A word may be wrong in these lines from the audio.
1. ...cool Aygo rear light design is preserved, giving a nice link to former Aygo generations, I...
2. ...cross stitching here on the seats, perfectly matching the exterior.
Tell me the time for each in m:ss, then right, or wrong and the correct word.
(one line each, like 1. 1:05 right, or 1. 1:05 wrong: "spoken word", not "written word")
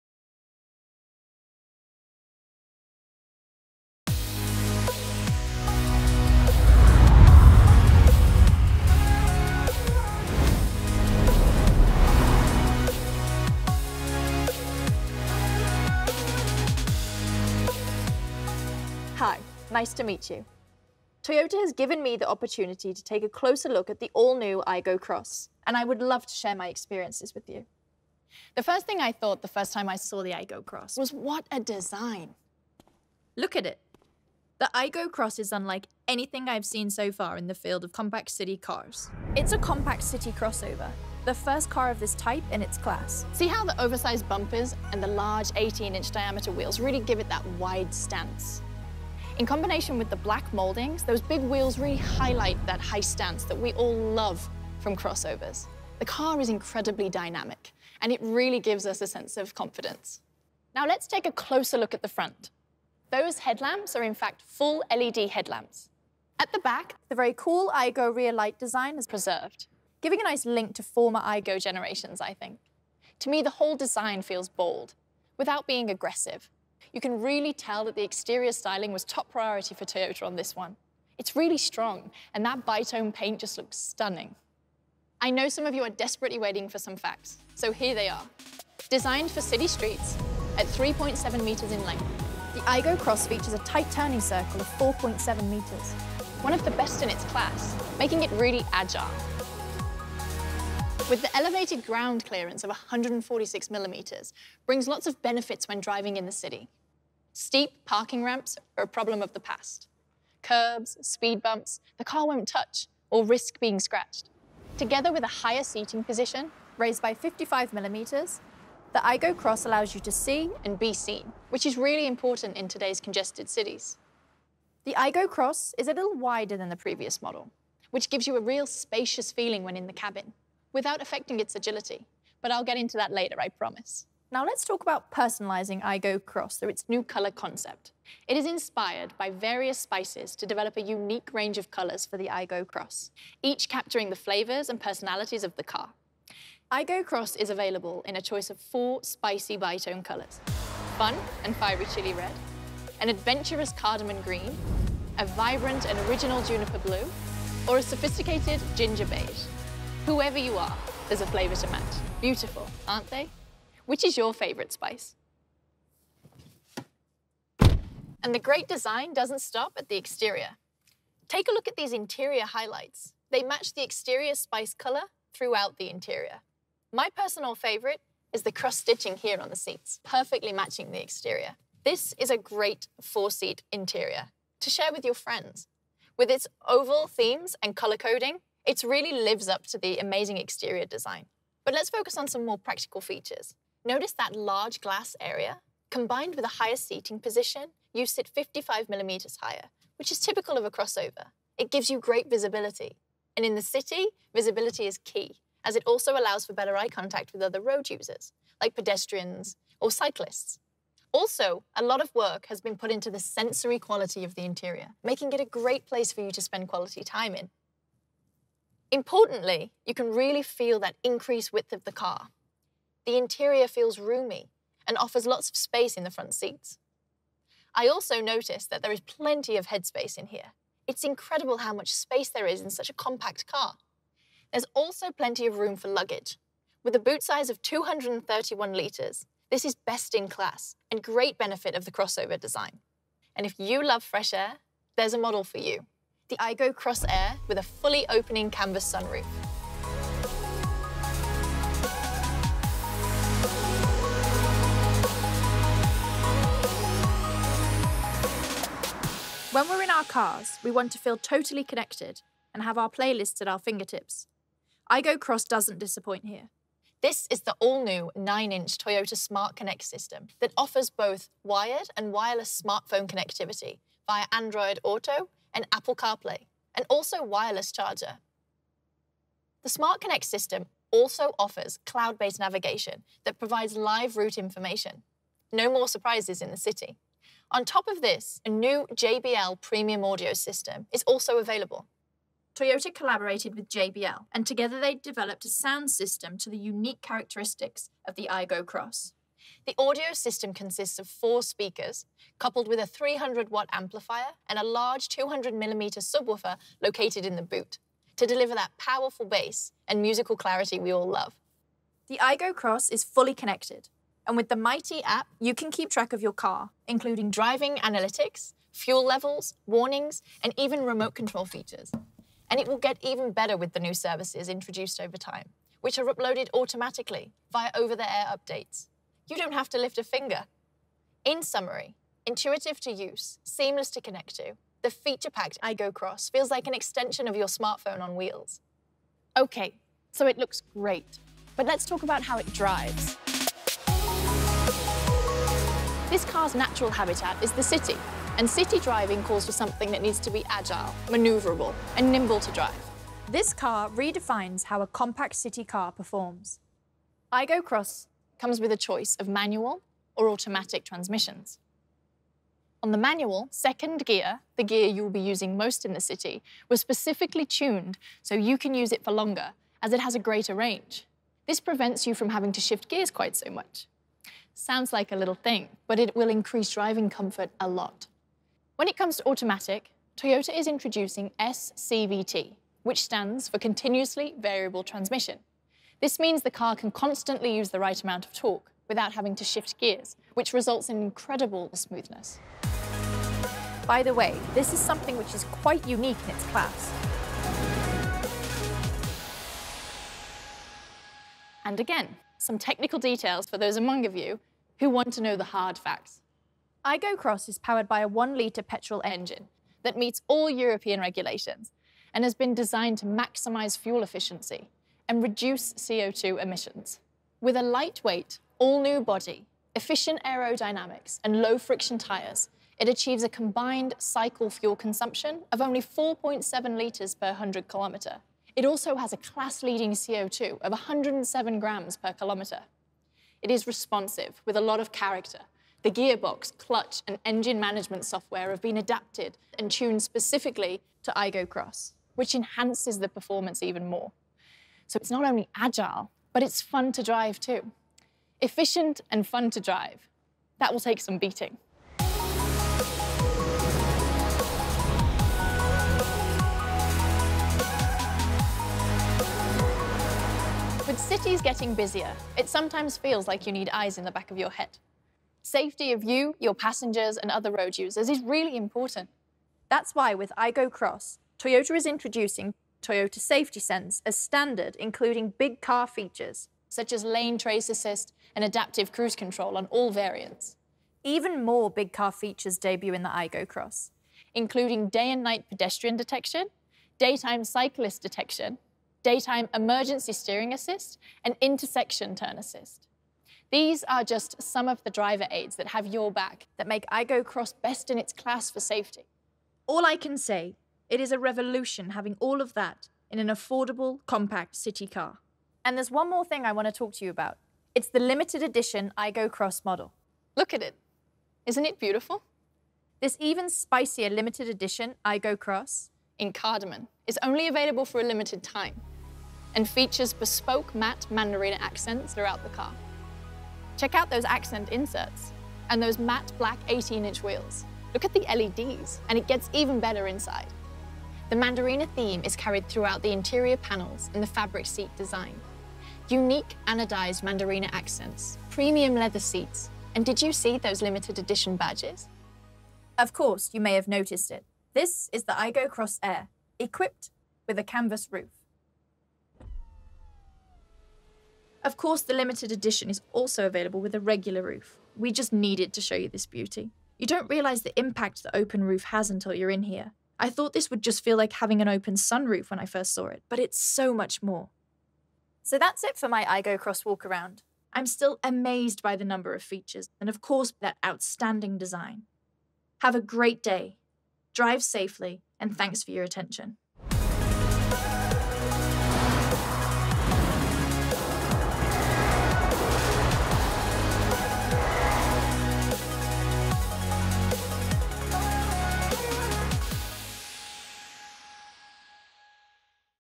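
1. 1:07 right
2. 2:58 right.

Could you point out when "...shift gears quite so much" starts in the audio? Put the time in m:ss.
6:12.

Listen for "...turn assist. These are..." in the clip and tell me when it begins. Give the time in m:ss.
8:12.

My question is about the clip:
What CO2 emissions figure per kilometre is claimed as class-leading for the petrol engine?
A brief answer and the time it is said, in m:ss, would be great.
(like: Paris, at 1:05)
107 grams, at 7:10.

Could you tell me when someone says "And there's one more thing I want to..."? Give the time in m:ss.
8:25.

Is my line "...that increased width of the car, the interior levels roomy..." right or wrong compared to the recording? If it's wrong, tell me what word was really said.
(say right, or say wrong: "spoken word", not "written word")
wrong: "feels", not "levels".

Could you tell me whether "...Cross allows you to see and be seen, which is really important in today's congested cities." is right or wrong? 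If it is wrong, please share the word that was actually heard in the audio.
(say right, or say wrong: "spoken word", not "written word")
right.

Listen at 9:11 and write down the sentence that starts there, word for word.
Of course, the limited edition is also available with a regular roof.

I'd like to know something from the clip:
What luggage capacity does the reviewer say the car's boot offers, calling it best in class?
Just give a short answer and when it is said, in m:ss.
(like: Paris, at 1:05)
231 litres, at 3:57.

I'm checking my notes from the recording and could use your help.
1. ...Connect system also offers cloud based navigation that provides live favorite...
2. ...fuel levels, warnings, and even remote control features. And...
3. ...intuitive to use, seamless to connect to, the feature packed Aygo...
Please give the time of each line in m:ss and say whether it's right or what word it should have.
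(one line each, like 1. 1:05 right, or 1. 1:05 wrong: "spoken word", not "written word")
1. 4:39 wrong: "route", not "favorite"
2. 5:18 right
3. 5:32 right.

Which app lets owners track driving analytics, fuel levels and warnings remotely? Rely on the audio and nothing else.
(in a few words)
MyT.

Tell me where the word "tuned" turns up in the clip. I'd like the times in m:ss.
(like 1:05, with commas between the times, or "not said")
6:07, 7:19.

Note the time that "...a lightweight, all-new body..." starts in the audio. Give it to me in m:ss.
6:57.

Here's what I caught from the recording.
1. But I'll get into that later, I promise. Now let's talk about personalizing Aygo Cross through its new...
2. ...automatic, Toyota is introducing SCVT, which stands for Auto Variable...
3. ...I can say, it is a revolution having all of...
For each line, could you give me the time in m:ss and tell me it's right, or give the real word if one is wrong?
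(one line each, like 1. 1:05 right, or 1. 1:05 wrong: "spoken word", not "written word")
1. 2:12 right
2. 6:19 wrong: "Continuously", not "Auto"
3. 8:19 right.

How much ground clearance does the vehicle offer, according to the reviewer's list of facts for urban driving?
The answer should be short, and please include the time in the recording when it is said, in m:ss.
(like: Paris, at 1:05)
146 millimeters, at 1:42.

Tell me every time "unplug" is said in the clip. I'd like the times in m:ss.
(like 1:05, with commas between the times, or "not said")
not said.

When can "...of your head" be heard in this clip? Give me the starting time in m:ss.
7:44.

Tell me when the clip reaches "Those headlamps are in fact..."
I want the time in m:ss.
1:03.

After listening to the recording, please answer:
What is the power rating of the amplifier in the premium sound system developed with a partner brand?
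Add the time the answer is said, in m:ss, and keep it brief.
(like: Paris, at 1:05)
300 watt, at 5:02.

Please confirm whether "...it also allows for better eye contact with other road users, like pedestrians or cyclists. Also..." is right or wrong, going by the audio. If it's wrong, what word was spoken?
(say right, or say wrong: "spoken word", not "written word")
right.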